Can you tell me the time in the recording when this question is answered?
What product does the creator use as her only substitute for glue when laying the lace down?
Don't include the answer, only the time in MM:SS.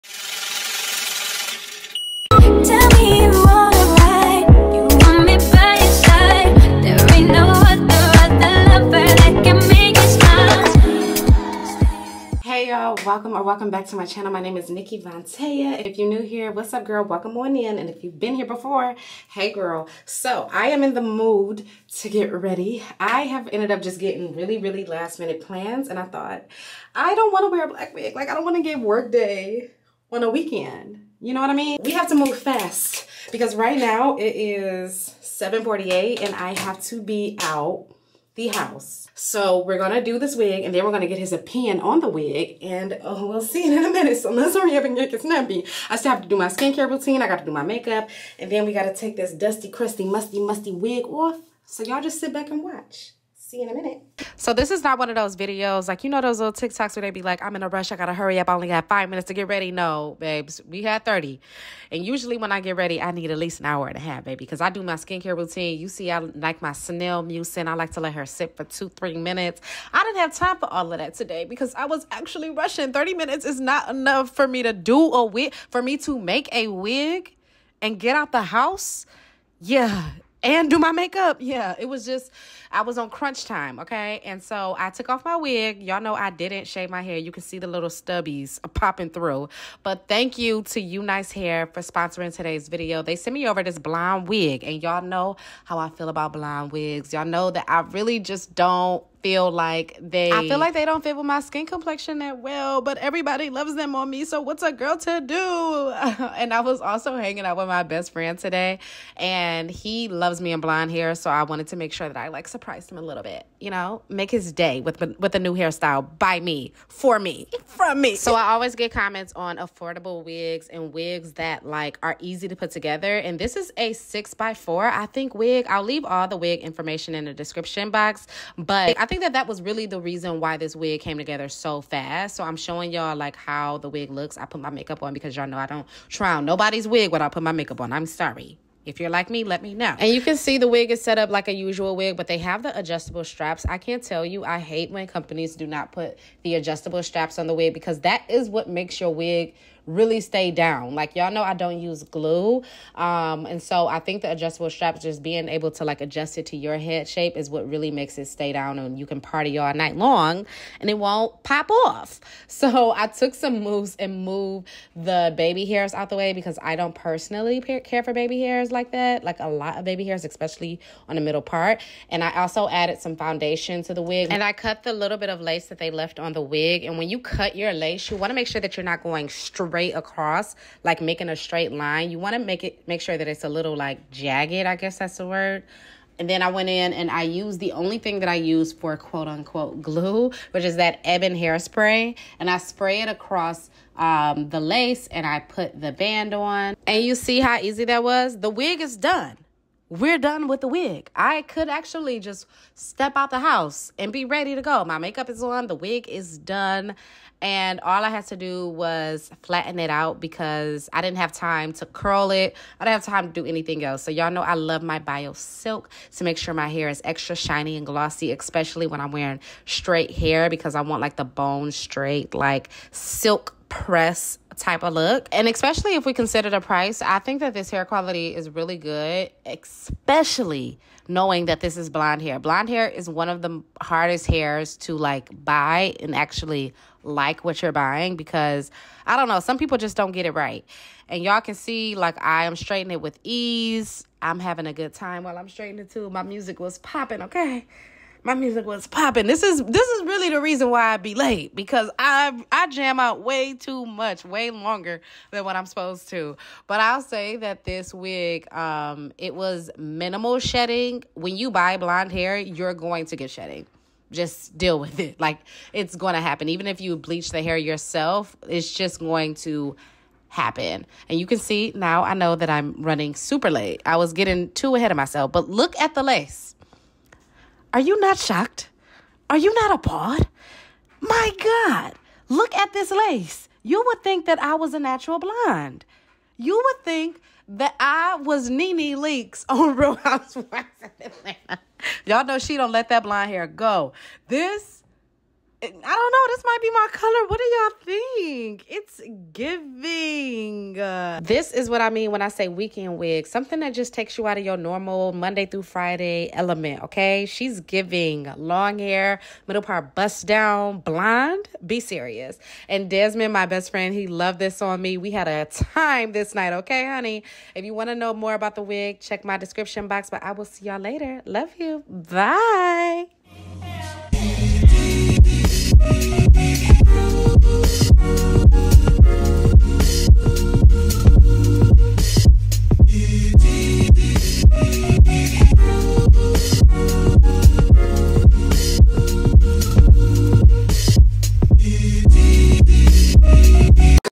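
03:11.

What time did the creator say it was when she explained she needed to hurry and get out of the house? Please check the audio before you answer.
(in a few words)
7:48.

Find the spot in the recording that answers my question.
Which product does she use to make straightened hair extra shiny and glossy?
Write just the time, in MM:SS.
03:34.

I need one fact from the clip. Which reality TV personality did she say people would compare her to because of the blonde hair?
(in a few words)
Nene Leakes.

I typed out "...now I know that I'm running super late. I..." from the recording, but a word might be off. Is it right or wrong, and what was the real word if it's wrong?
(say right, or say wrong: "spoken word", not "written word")
right.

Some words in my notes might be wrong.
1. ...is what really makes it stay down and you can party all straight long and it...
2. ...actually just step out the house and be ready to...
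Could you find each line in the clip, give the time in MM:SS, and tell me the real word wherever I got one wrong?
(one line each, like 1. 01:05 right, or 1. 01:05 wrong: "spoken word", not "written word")
1. 02:37 wrong: "night", not "straight"
2. 03:21 right.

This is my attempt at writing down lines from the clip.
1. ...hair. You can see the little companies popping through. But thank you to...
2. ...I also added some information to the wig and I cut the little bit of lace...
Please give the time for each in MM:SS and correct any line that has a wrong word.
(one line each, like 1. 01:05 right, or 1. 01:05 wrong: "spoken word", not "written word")
1. 01:27 wrong: "stubbies", not "companies"
2. 02:52 wrong: "foundation", not "information".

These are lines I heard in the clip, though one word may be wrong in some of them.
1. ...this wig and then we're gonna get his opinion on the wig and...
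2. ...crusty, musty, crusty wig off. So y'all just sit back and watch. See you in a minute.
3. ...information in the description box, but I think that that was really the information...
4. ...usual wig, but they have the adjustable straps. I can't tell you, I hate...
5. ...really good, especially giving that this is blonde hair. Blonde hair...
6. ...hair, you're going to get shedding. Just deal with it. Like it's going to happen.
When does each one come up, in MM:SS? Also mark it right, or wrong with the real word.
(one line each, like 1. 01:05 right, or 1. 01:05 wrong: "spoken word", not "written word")
1. 00:40 right
2. 00:49 wrong: "musty", not "crusty"
3. 02:06 wrong: "reason", not "information"
4. 02:21 right
5. 03:48 wrong: "knowing", not "giving"
6. 04:22 right.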